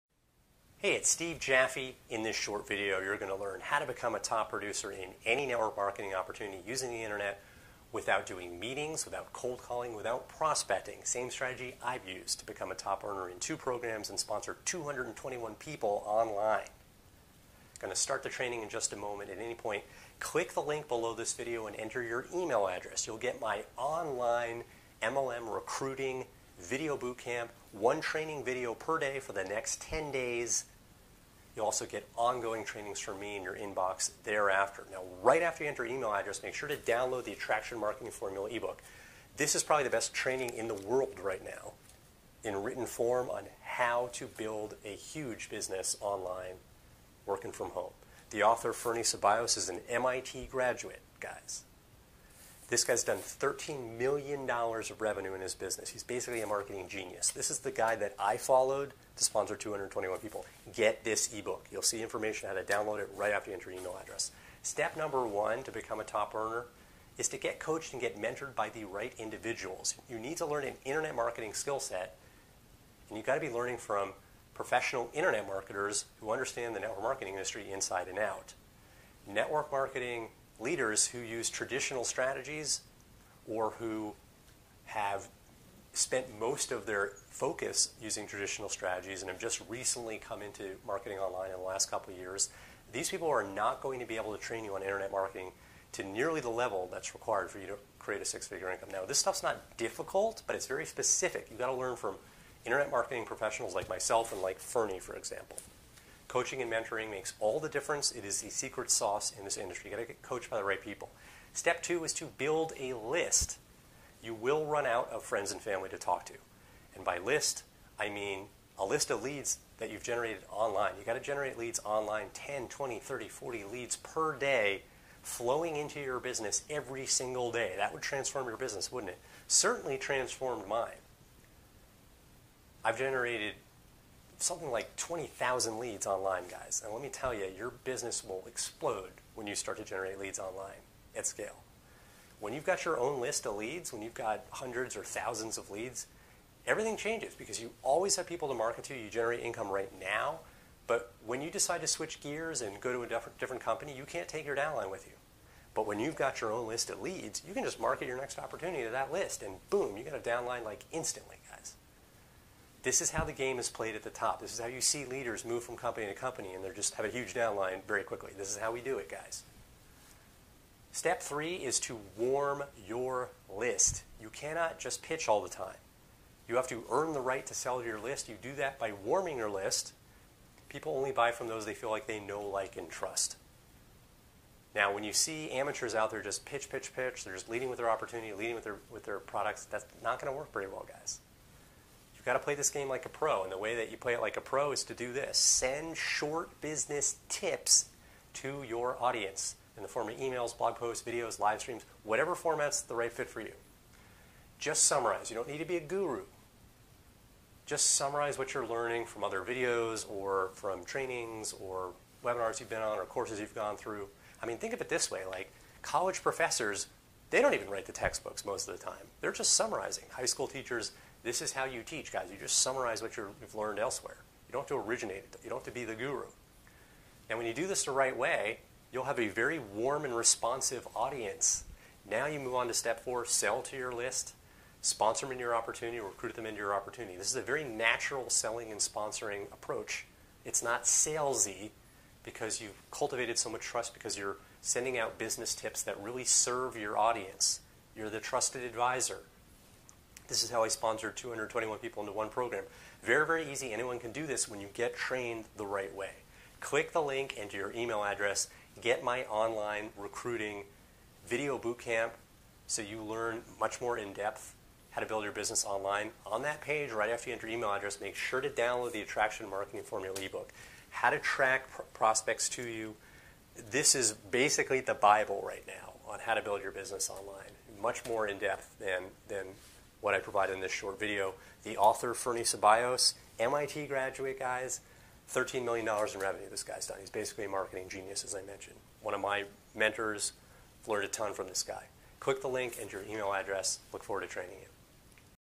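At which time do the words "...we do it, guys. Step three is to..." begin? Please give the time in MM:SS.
02:48.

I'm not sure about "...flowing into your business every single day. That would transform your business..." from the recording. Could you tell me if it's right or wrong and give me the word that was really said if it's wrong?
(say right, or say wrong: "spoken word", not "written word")
right.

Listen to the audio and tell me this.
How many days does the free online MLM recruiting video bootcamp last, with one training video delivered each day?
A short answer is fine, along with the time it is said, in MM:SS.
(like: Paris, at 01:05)
10 days, at 00:29.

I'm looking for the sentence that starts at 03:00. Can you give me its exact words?
People only buy from those they feel like they know, like, and trust.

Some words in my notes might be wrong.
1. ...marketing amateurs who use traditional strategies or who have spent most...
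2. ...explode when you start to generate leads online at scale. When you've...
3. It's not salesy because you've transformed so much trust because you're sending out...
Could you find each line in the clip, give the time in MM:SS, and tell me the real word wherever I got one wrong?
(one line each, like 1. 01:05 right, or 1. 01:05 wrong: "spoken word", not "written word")
1. 01:19 wrong: "leaders", not "amateurs"
2. 02:18 right
3. 04:00 wrong: "cultivated", not "transformed".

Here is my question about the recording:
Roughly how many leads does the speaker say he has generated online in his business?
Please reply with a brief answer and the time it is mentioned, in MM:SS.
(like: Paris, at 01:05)
20,000, at 02:14.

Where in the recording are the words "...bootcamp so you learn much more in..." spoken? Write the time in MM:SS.
04:21.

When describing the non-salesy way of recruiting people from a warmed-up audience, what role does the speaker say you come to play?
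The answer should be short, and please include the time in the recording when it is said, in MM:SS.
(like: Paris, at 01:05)
The trusted advisor, at 04:08.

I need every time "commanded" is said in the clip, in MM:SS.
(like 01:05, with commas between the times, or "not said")
not said.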